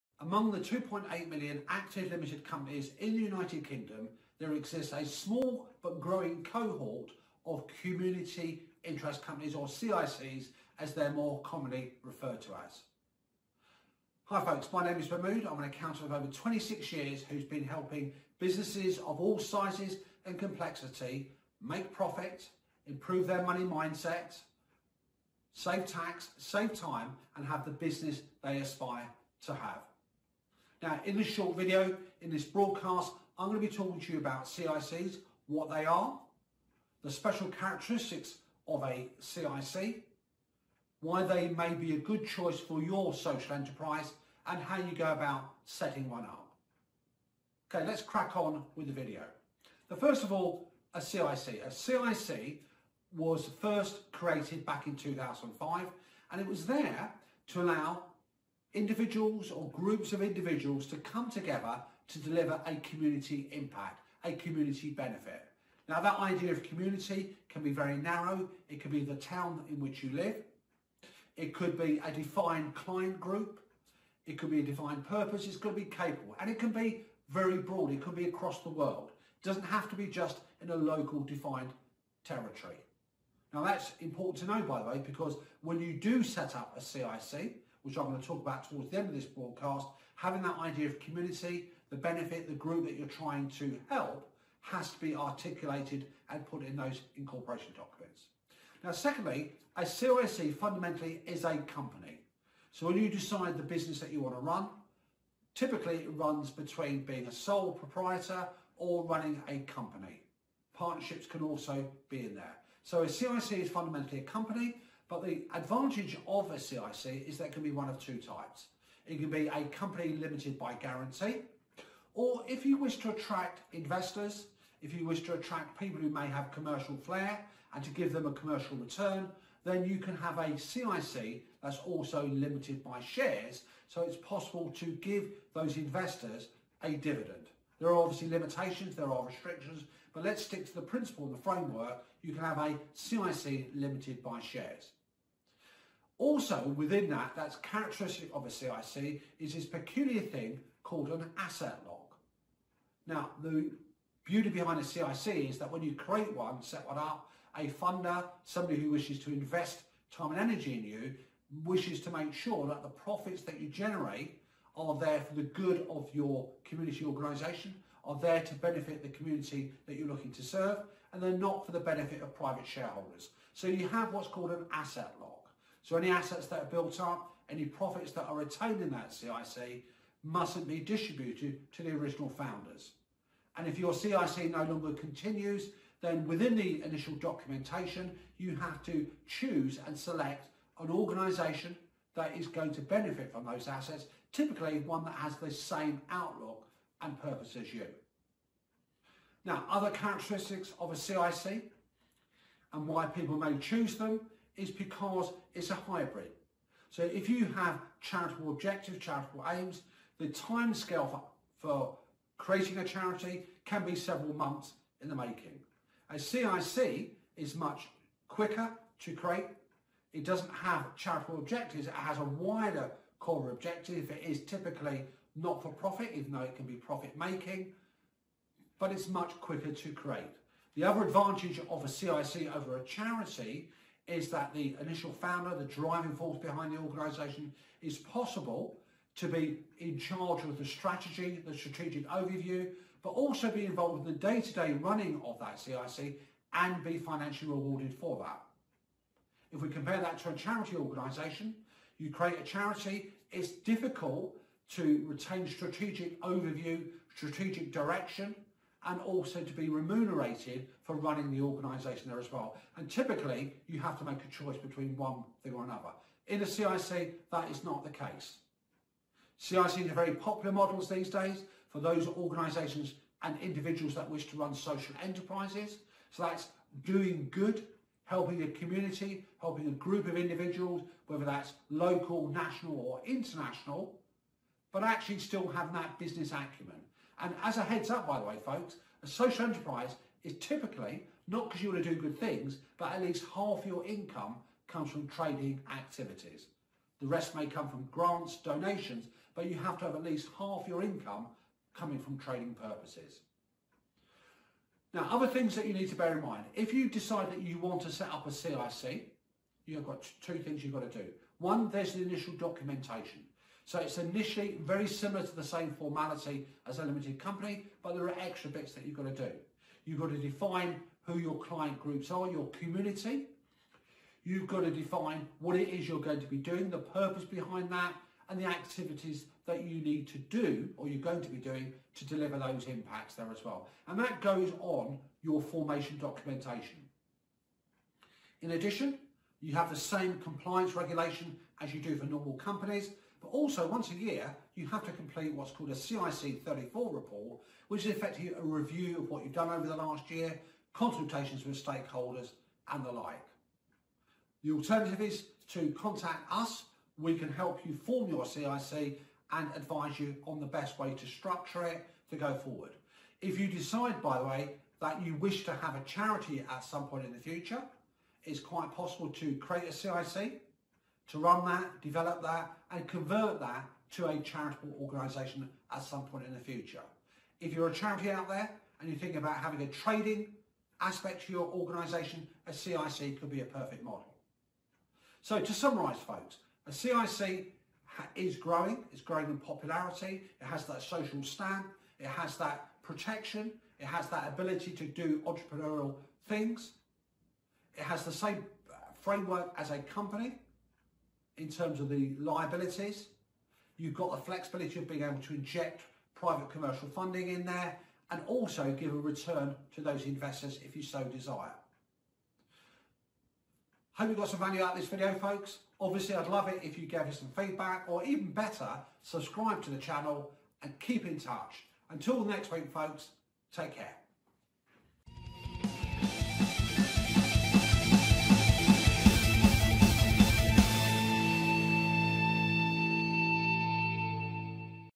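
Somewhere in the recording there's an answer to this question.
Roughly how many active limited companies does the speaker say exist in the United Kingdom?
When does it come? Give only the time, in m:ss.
0:00.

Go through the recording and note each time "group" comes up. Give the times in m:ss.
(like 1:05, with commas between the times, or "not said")
0:59, 1:13, 1:32, 4:39, 5:21.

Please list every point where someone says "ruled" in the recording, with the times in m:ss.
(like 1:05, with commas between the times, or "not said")
not said.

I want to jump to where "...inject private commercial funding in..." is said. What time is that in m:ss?
6:45.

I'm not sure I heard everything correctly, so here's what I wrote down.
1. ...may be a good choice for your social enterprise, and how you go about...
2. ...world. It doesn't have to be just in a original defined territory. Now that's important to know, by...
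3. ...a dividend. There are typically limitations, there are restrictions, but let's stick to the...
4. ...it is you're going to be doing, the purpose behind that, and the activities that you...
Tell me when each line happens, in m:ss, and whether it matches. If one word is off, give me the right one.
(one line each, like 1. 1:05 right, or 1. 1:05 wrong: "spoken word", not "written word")
1. 0:41 right
2. 1:18 wrong: "local", not "original"
3. 2:16 wrong: "obviously", not "typically"
4. 5:25 right.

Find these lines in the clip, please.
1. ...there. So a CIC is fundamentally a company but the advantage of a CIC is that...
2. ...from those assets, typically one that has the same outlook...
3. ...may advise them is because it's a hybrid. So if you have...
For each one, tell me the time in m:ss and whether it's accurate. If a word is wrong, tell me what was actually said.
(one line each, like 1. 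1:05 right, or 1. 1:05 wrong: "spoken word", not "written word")
1. 1:52 right
2. 3:13 right
3. 3:23 wrong: "choose", not "advise".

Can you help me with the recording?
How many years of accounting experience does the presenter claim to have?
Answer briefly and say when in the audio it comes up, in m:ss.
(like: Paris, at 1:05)
26, at 0:16.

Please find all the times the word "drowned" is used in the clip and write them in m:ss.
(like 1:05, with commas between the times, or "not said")
not said.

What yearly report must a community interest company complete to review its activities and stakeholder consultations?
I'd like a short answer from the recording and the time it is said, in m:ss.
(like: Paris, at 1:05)
CIC 34 report, at 5:45.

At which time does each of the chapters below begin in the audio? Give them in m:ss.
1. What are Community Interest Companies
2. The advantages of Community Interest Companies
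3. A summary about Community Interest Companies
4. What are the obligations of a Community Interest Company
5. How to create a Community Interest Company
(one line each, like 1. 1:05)
1. 0:49
2. 3:36
3. 6:25
4. 5:38
5. 5:08.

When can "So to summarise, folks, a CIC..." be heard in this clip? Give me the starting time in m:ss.
6:25.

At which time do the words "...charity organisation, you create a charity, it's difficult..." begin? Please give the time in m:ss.
4:10.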